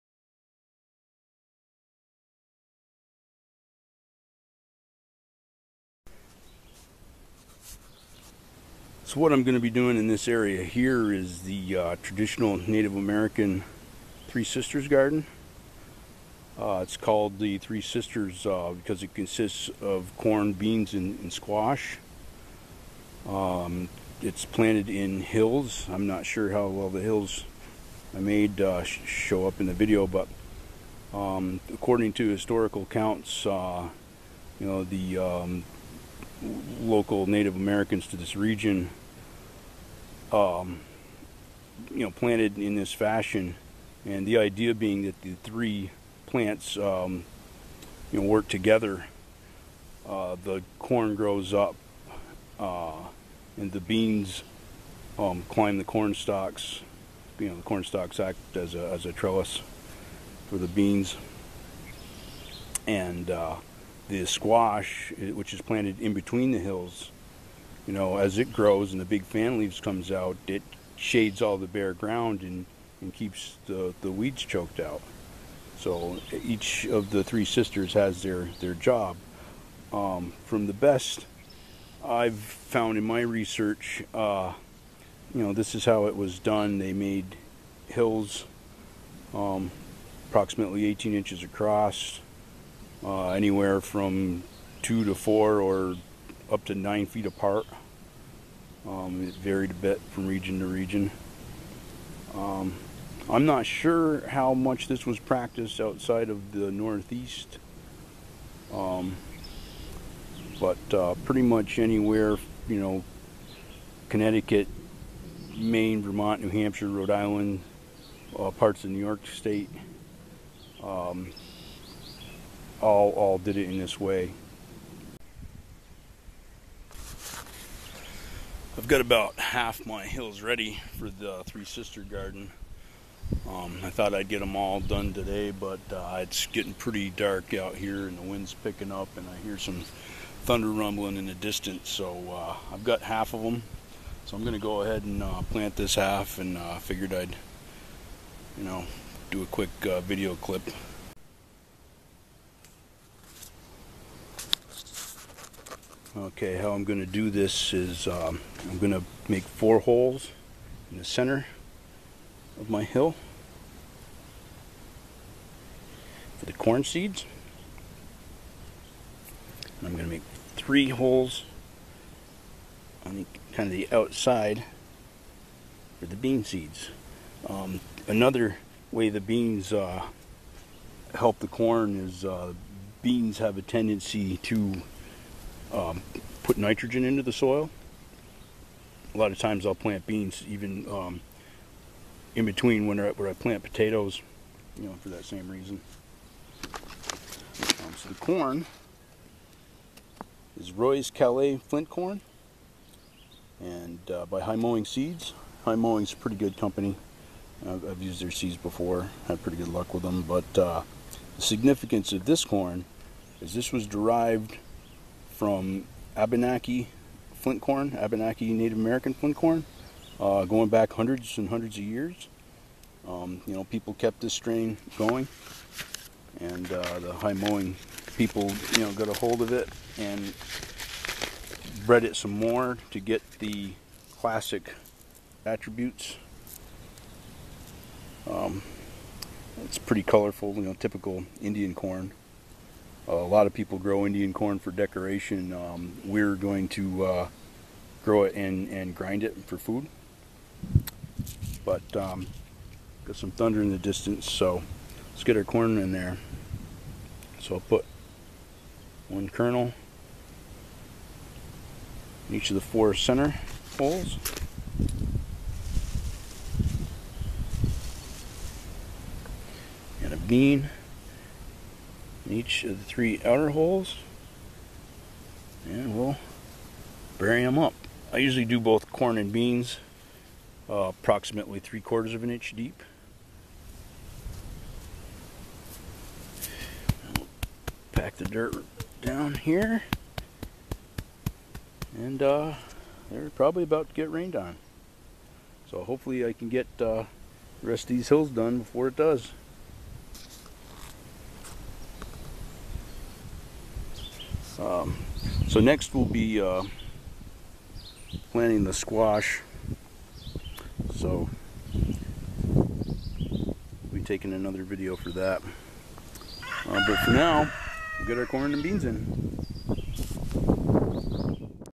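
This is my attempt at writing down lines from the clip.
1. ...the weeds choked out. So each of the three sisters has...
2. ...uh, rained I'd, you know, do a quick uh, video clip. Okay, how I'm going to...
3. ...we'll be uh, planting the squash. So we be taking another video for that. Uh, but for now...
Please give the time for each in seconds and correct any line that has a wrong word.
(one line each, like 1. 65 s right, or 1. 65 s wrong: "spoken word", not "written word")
1. 74 s right
2. 146 s wrong: "figured", not "rained"
3. 305 s right.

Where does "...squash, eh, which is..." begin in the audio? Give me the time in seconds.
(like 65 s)
64 s.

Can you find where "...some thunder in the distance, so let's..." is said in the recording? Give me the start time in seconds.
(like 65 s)
253 s.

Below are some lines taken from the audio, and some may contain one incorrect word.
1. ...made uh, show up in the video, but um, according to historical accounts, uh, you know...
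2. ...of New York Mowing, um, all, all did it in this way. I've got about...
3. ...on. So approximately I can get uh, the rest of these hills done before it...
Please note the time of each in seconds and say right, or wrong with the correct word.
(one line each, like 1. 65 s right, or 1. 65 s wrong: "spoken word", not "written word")
1. 28 s right
2. 118 s wrong: "State", not "Mowing"
3. 294 s wrong: "hopefully", not "approximately".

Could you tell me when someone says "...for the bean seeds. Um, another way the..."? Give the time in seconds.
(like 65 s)
176 s.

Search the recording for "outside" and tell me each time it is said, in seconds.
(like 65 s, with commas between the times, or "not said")
105 s, 173 s.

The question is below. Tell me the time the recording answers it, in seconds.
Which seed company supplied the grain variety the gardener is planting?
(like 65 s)
204 s.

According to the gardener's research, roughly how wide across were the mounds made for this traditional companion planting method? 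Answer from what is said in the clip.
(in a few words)
18 inches.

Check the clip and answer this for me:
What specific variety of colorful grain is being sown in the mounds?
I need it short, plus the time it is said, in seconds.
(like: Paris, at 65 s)
Roy's Calais Flint corn, at 200 s.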